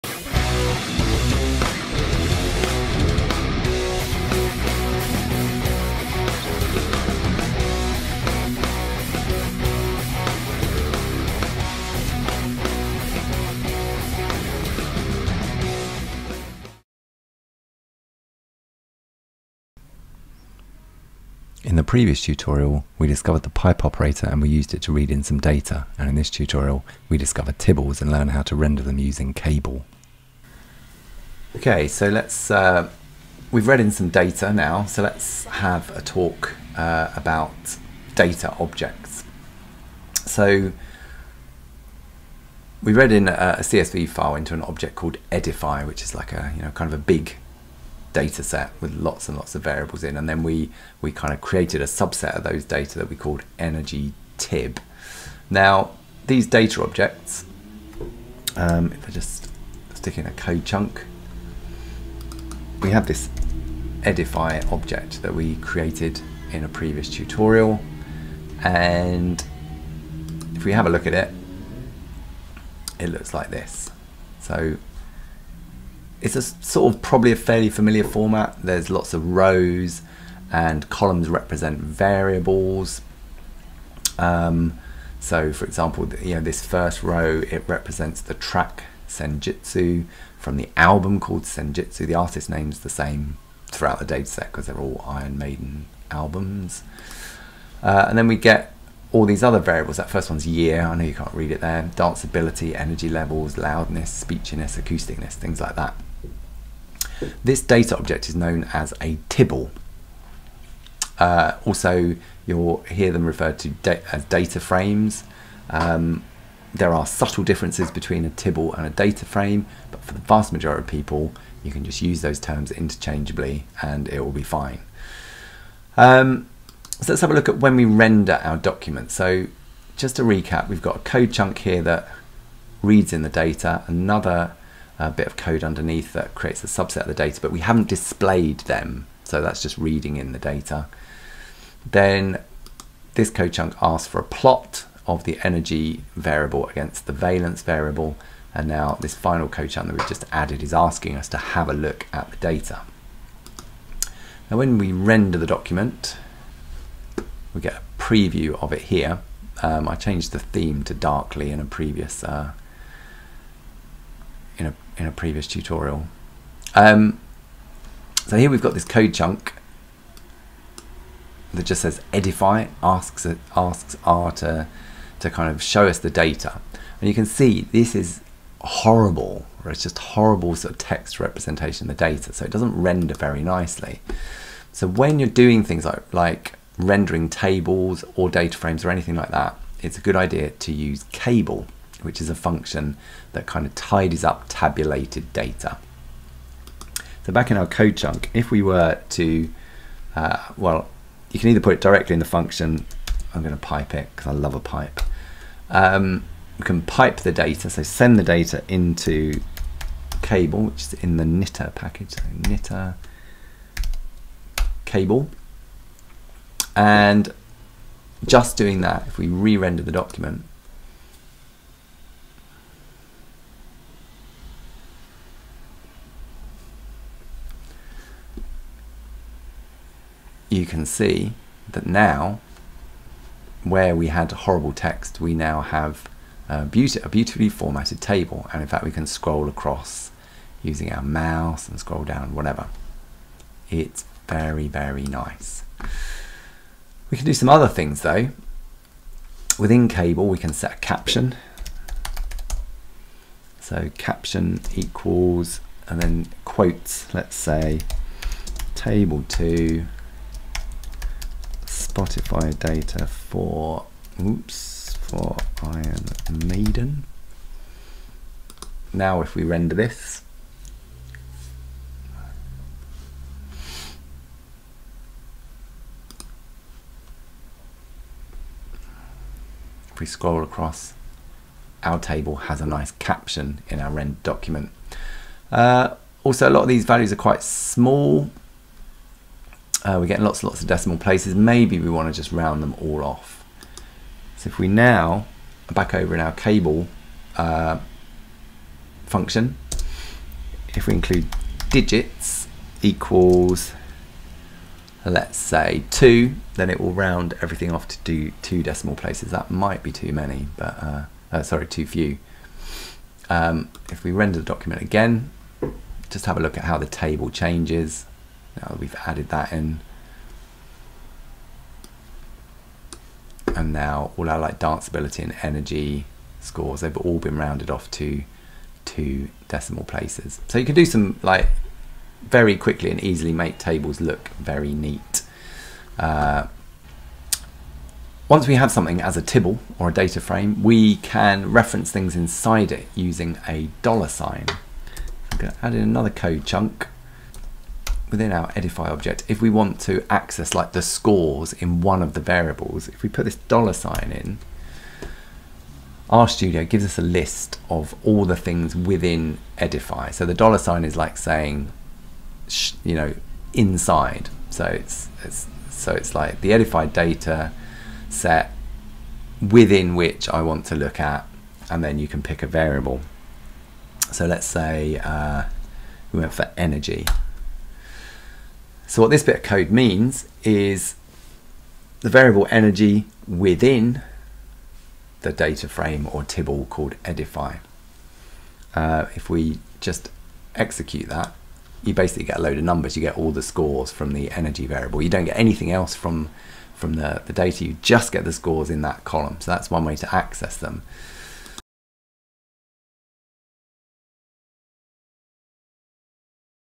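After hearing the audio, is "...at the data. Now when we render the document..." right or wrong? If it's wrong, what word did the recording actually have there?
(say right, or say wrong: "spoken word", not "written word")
right.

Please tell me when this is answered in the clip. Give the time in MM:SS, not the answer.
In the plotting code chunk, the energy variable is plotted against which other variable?
02:27.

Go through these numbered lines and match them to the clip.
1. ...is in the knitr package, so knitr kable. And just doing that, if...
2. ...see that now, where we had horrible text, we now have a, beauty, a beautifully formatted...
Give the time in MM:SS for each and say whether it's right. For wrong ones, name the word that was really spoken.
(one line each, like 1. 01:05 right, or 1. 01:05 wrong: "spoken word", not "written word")
1. 03:30 right
2. 03:50 right.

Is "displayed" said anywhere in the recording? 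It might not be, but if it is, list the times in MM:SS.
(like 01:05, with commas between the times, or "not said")
02:17.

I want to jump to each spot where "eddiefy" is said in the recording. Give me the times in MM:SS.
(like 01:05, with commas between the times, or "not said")
00:45, 01:04, 02:52, 05:48, 05:59, 06:27.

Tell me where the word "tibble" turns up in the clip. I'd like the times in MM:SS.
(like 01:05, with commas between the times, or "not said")
00:27, 01:49, 01:58, 05:39, 06:26.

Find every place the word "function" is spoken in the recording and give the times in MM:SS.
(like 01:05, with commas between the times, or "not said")
03:12, 03:22, 04:59.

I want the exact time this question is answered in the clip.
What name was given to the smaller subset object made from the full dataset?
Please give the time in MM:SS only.
00:53.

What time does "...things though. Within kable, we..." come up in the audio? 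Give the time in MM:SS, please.
04:07.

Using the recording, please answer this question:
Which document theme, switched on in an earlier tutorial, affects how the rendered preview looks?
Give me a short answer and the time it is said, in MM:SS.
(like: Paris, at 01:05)
darkly, at 02:40.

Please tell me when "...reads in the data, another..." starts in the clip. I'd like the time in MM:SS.
02:12.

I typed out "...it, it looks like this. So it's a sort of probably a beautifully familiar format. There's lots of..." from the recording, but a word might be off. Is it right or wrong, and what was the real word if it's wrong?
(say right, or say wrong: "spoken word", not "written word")
wrong: "fairly", not "beautifully".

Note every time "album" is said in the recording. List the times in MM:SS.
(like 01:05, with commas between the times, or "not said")
01:30, 01:36.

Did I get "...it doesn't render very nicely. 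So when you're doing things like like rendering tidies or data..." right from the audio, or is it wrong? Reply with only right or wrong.
wrong.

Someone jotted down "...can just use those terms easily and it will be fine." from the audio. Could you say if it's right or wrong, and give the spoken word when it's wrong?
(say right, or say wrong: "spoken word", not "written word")
wrong: "interchangeably", not "easily".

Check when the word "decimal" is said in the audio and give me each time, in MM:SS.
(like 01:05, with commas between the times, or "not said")
04:50, 05:08, 05:29.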